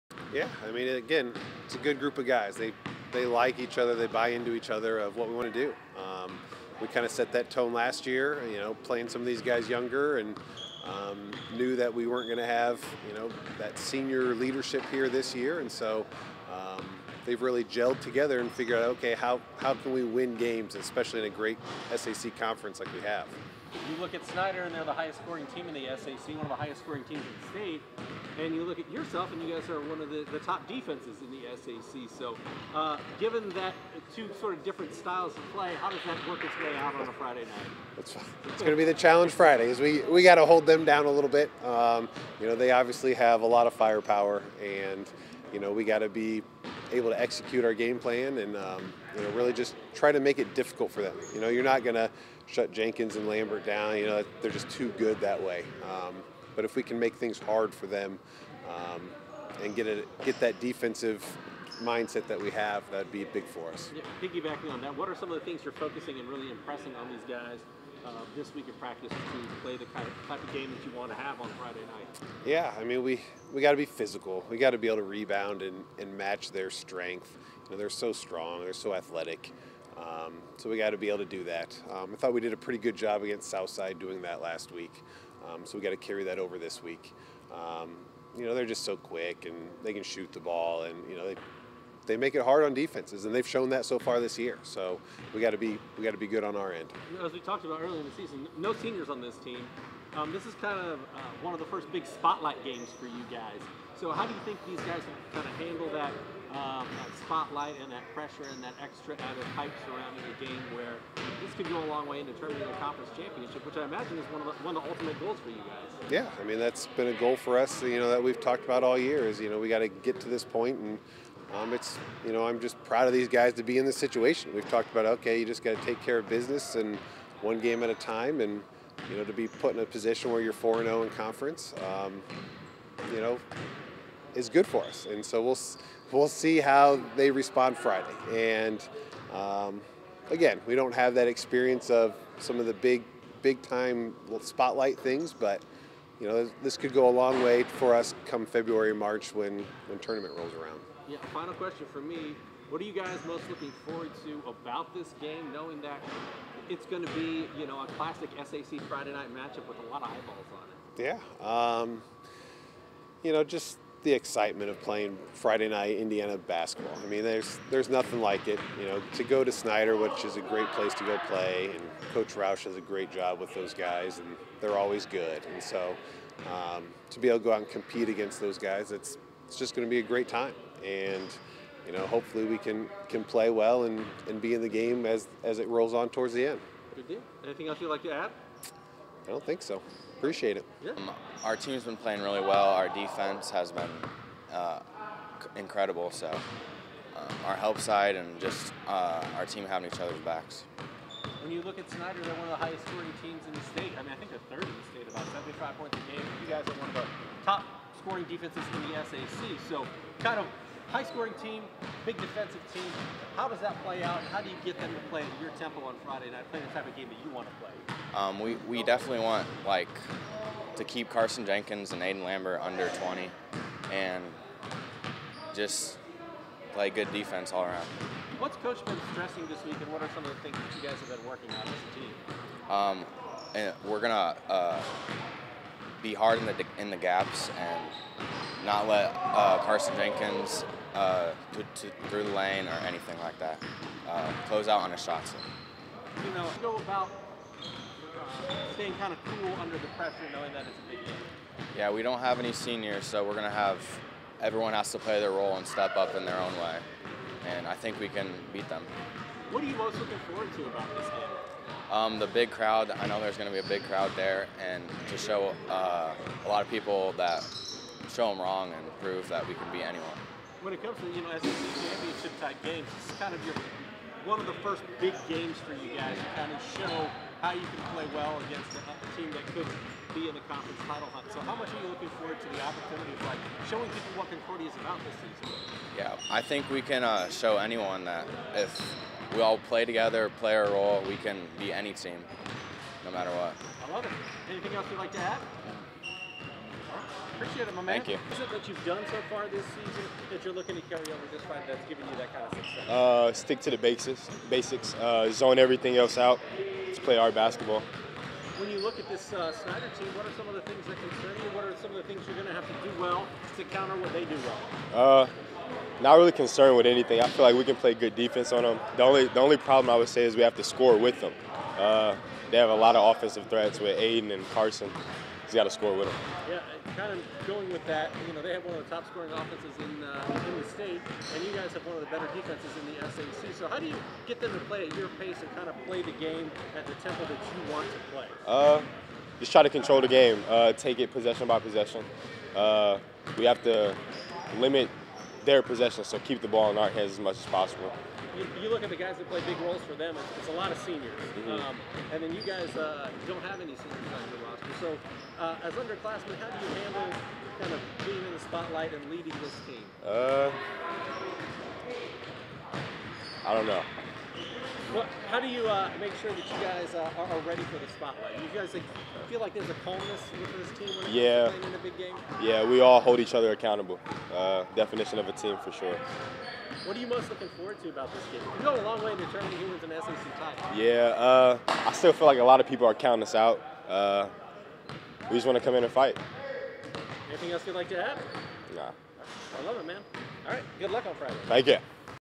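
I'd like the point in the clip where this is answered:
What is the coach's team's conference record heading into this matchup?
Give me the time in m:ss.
2:10.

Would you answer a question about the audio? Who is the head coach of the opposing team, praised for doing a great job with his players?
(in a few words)
Coach Roush.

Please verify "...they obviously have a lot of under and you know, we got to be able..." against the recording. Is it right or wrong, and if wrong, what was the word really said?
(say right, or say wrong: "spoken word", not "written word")
wrong: "firepower", not "under".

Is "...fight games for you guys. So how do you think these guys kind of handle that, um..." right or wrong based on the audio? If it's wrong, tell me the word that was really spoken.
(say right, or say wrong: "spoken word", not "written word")
wrong: "spotlight", not "fight".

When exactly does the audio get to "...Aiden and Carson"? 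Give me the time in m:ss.
5:23.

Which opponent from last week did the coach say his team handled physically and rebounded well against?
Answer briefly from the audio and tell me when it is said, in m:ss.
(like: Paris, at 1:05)
Southside, at 1:23.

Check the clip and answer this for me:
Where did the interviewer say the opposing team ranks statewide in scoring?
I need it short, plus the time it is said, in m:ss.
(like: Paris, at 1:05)
third, at 3:24.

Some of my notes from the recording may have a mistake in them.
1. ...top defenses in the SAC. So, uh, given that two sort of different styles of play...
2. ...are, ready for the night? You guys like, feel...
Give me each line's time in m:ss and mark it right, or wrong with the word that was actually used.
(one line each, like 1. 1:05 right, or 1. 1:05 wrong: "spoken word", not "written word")
1. 0:30 right
2. 6:07 wrong: "spotlight", not "night".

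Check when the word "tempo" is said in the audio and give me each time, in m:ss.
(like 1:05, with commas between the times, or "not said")
3:35, 5:37.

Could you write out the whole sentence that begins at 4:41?
So how much are you looking forward to the opportunity of like showing people what Concordia is about this season?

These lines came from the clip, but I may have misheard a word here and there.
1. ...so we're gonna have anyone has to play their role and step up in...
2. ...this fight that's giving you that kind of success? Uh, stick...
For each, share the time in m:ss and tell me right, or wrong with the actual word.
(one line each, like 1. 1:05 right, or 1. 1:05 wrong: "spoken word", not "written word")
1. 4:13 wrong: "everyone", not "anyone"
2. 5:01 right.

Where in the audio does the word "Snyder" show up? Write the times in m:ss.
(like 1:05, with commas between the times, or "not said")
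0:24, 2:49, 3:21, 5:09.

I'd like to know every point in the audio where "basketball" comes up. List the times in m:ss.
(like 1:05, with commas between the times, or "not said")
2:46, 5:07.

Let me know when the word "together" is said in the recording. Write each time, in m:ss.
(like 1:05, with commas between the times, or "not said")
0:17, 4:49.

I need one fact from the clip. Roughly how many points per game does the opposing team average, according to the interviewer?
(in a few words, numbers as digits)
75.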